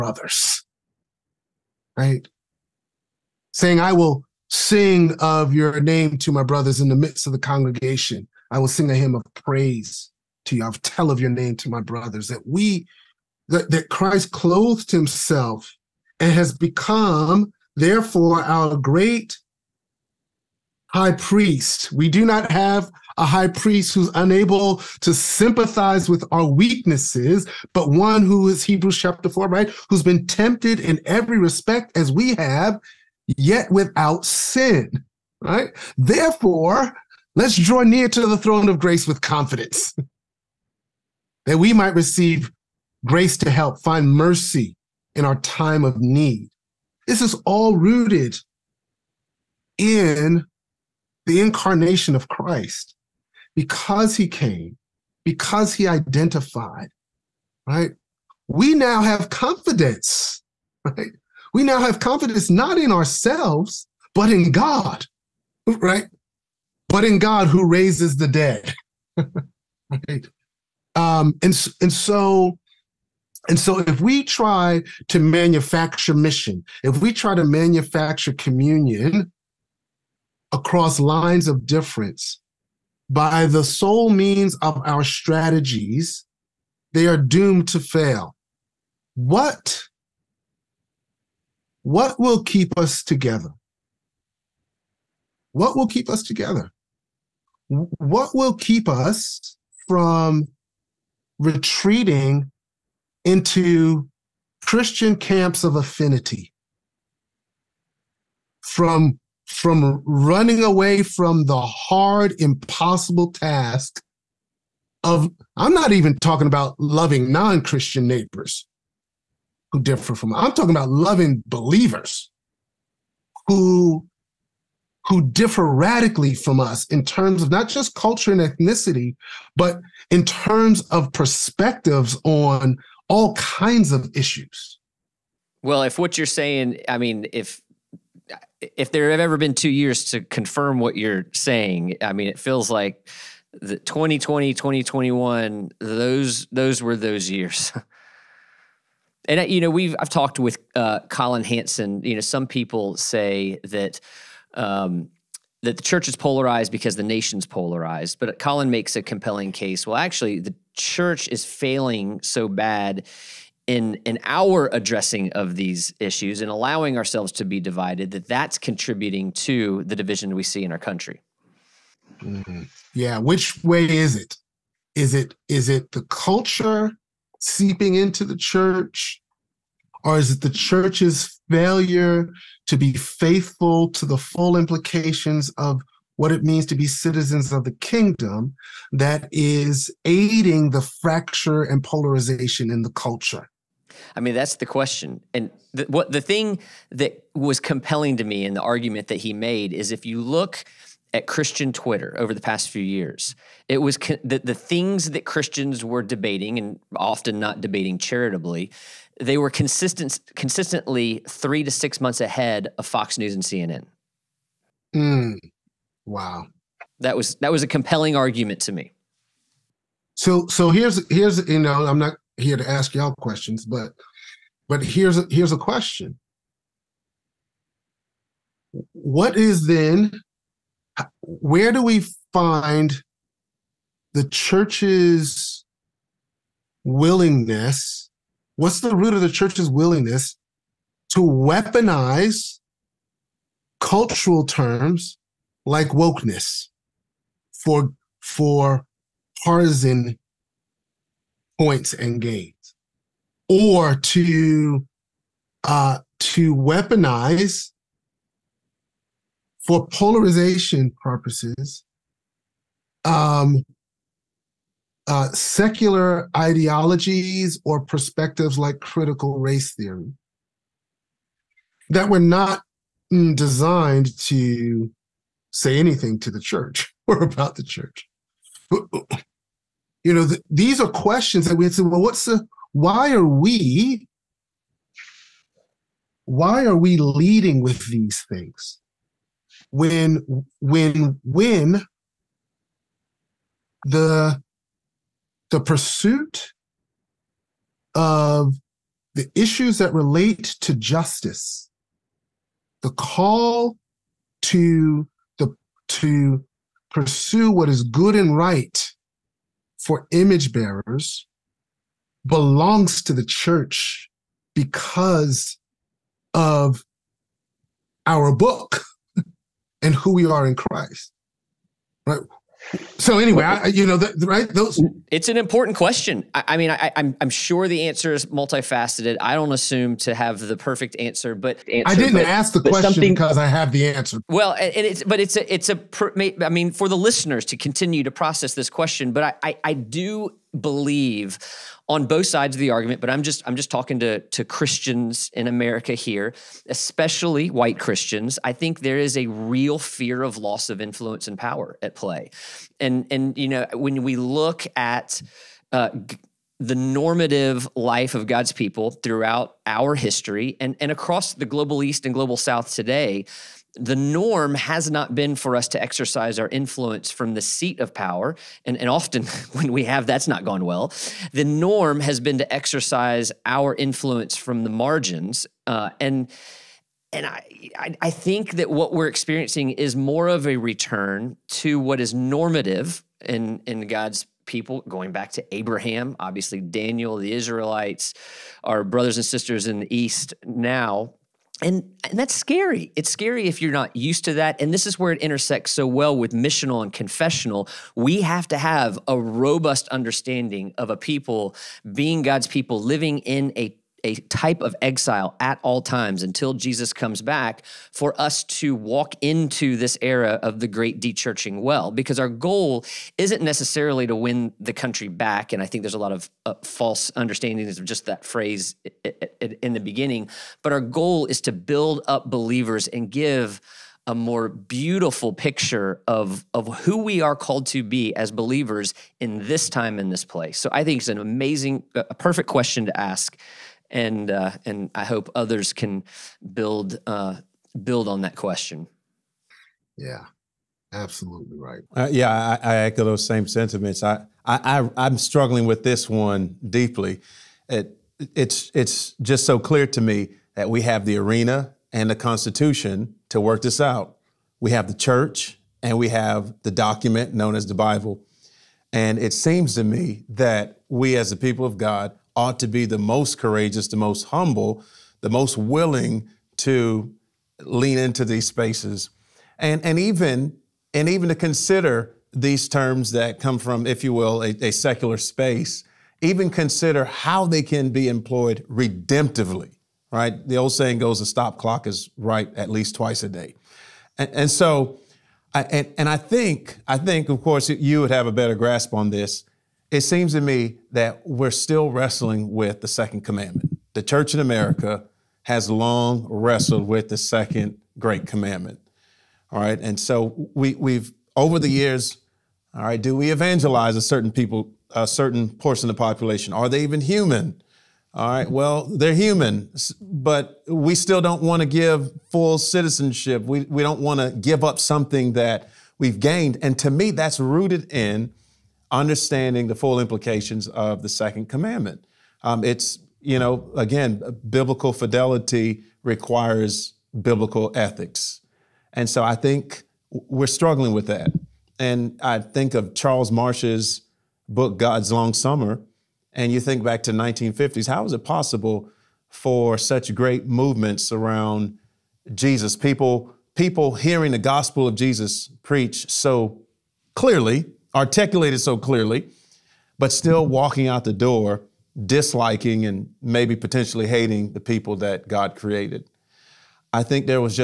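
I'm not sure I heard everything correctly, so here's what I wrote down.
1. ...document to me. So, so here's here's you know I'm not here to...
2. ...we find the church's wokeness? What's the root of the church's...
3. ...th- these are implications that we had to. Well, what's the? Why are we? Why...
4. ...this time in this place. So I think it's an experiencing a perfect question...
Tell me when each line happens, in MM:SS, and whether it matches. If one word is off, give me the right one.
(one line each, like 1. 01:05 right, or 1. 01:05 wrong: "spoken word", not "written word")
1. 03:38 wrong: "argument", not "document"
2. 03:51 wrong: "willingness", not "wokeness"
3. 04:40 wrong: "questions", not "implications"
4. 07:09 wrong: "amazing", not "experiencing".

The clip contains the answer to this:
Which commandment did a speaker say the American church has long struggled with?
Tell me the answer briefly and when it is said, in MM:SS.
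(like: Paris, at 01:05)
the second great commandment, at 08:17.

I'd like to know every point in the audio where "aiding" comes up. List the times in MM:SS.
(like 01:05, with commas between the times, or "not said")
03:10.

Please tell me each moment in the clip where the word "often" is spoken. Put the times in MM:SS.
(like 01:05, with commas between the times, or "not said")
03:26, 06:08.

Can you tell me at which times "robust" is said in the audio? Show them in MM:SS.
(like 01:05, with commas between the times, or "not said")
06:39.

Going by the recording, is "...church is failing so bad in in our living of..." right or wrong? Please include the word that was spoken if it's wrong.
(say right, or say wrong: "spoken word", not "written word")
wrong: "addressing", not "living".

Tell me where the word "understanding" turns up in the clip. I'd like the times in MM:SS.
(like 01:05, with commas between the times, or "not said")
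06:39, 06:57, 08:38.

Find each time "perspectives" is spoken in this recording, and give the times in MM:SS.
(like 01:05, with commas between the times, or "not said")
02:11, 04:27.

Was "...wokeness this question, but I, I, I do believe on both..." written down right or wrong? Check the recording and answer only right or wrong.
wrong.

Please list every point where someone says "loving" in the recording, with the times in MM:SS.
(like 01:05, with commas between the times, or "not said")
01:56, 02:00.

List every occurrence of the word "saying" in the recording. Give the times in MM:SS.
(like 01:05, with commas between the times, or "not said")
00:03, 02:16, 02:21, 08:00.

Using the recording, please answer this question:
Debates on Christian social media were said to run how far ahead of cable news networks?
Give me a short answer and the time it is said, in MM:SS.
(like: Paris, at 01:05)
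3 to 6 months, at 03:31.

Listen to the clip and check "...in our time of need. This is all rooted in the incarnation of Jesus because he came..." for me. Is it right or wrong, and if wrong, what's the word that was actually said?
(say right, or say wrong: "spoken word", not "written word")
wrong: "Christ", not "Jesus".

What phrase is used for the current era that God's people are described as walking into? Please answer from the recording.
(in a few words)
the great dechurching.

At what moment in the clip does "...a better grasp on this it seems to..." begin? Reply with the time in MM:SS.
08:08.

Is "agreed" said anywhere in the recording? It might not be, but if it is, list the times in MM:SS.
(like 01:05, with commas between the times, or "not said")
not said.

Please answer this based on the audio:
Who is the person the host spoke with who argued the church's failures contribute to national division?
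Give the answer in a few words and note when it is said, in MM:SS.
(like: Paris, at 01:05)
Colin Hansen, at 02:31.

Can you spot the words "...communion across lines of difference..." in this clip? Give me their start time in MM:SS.
01:18.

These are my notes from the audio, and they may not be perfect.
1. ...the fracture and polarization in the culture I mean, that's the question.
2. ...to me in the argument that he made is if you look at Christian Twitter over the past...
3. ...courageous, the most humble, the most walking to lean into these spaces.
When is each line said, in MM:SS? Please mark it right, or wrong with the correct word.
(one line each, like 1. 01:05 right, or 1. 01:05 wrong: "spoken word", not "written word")
1. 03:10 right
2. 03:18 right
3. 07:43 wrong: "willing", not "walking".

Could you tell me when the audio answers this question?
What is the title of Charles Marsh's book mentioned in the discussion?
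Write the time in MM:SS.
08:54.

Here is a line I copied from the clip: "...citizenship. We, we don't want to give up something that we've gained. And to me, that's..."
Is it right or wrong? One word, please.
right.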